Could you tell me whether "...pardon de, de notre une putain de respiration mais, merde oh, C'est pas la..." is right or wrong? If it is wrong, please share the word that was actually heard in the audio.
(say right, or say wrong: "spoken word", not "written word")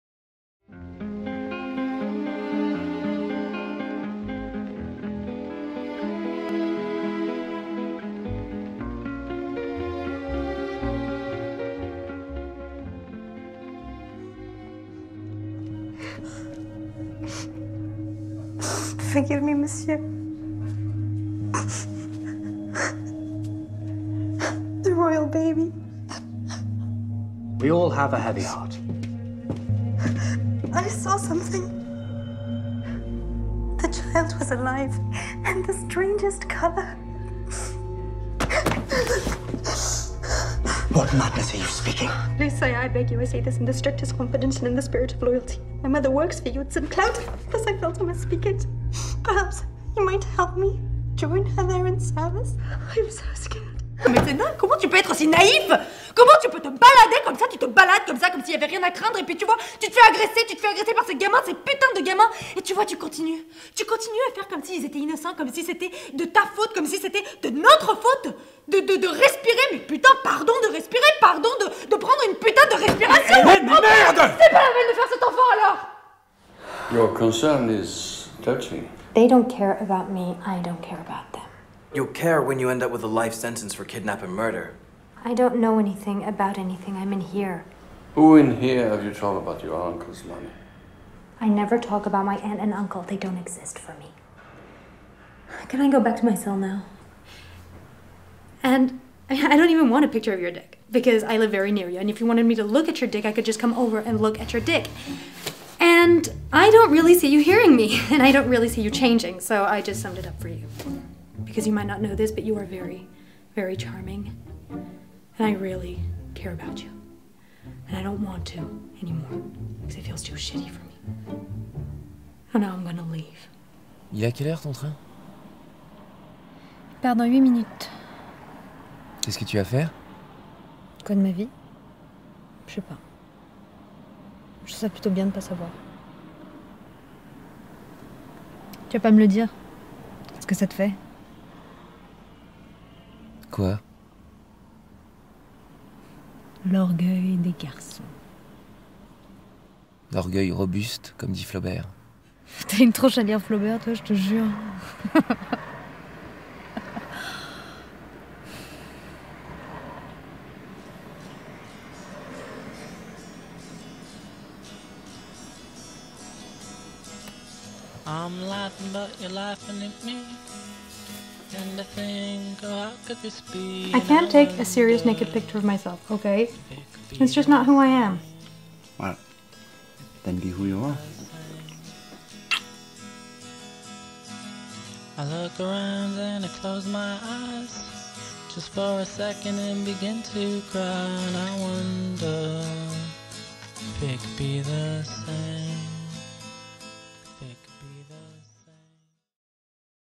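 wrong: "prendre", not "notre".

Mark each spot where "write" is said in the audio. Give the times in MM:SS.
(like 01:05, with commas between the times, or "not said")
not said.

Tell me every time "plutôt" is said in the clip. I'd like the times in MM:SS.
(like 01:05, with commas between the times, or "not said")
02:14.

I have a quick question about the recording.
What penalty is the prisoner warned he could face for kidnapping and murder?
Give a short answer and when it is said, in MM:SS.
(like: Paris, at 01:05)
life sentence, at 01:23.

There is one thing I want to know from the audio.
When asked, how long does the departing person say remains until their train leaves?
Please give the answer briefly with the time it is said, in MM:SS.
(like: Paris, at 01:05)
8 minutes, at 02:07.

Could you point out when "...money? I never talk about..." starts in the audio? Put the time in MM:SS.
01:30.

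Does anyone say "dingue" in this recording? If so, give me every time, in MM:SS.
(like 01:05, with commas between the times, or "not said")
00:54.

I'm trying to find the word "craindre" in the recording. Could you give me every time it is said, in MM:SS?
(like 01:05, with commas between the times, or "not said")
00:58.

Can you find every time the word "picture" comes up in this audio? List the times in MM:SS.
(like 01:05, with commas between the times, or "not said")
01:40, 02:55.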